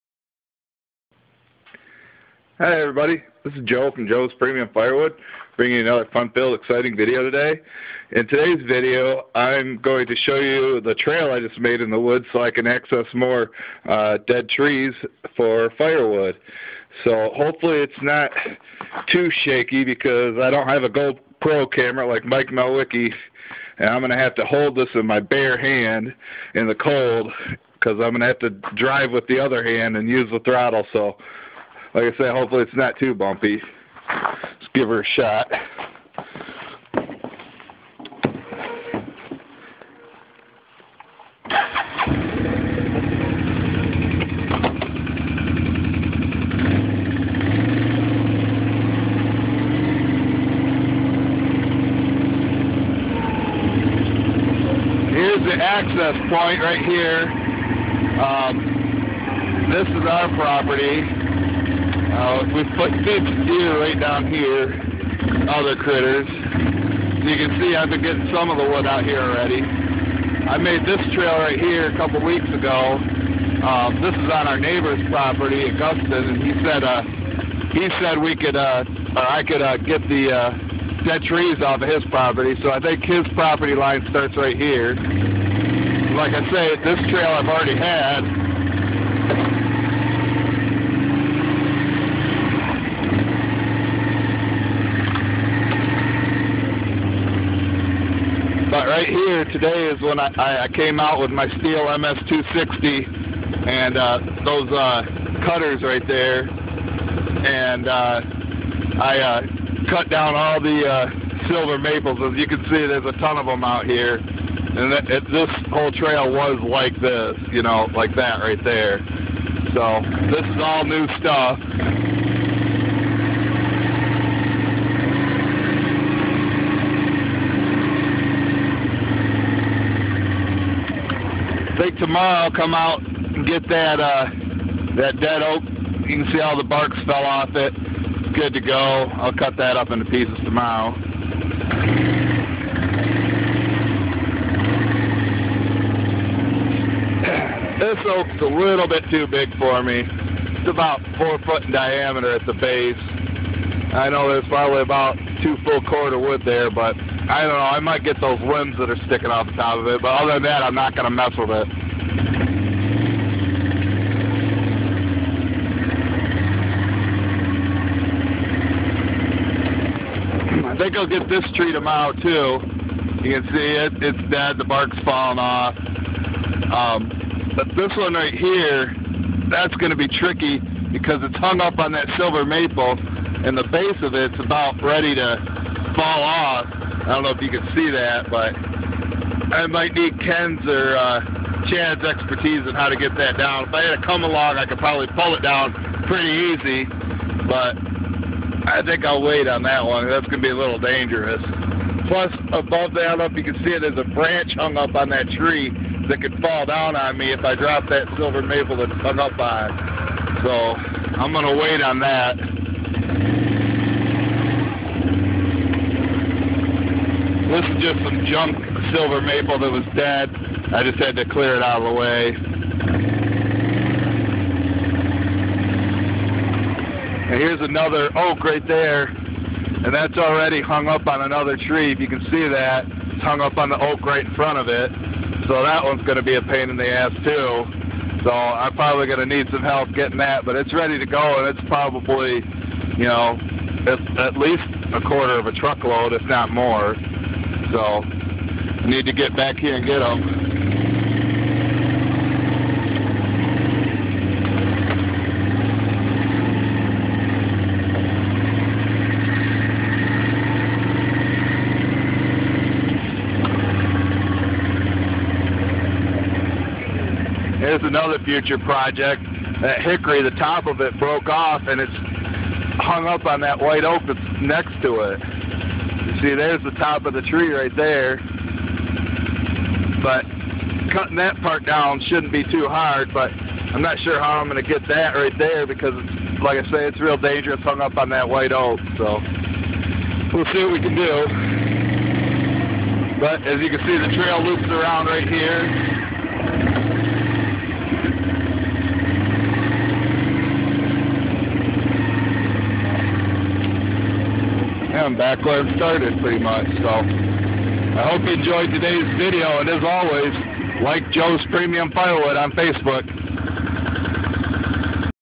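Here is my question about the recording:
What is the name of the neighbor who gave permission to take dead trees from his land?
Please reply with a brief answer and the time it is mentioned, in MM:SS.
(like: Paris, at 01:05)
Augustin, at 01:15.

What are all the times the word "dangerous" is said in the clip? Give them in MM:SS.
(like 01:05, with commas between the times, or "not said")
03:20, 04:47.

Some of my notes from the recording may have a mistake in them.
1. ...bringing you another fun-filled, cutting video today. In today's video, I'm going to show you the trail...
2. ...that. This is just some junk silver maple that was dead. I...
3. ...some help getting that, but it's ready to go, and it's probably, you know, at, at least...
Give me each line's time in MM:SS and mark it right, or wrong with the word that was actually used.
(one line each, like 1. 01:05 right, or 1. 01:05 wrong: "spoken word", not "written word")
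1. 00:05 wrong: "exciting", not "cutting"
2. 03:31 right
3. 03:59 right.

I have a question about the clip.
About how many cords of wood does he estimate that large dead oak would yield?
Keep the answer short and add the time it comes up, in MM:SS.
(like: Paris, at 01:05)
2 full cords, at 02:35.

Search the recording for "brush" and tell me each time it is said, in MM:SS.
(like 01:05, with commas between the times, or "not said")
not said.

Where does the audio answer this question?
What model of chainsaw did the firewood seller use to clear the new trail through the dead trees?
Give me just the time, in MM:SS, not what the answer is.
01:41.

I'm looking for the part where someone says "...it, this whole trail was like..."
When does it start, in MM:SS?
01:55.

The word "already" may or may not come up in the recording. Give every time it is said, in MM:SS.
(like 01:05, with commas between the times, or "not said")
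01:09, 01:27, 03:50.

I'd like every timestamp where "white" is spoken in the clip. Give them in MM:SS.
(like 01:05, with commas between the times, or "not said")
04:33, 04:48.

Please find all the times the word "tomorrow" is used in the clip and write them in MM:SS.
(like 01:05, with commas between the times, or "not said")
02:11, 02:20, 02:51.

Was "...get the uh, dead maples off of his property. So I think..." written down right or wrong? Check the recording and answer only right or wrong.
wrong.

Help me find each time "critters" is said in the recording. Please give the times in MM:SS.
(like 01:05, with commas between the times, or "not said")
01:05.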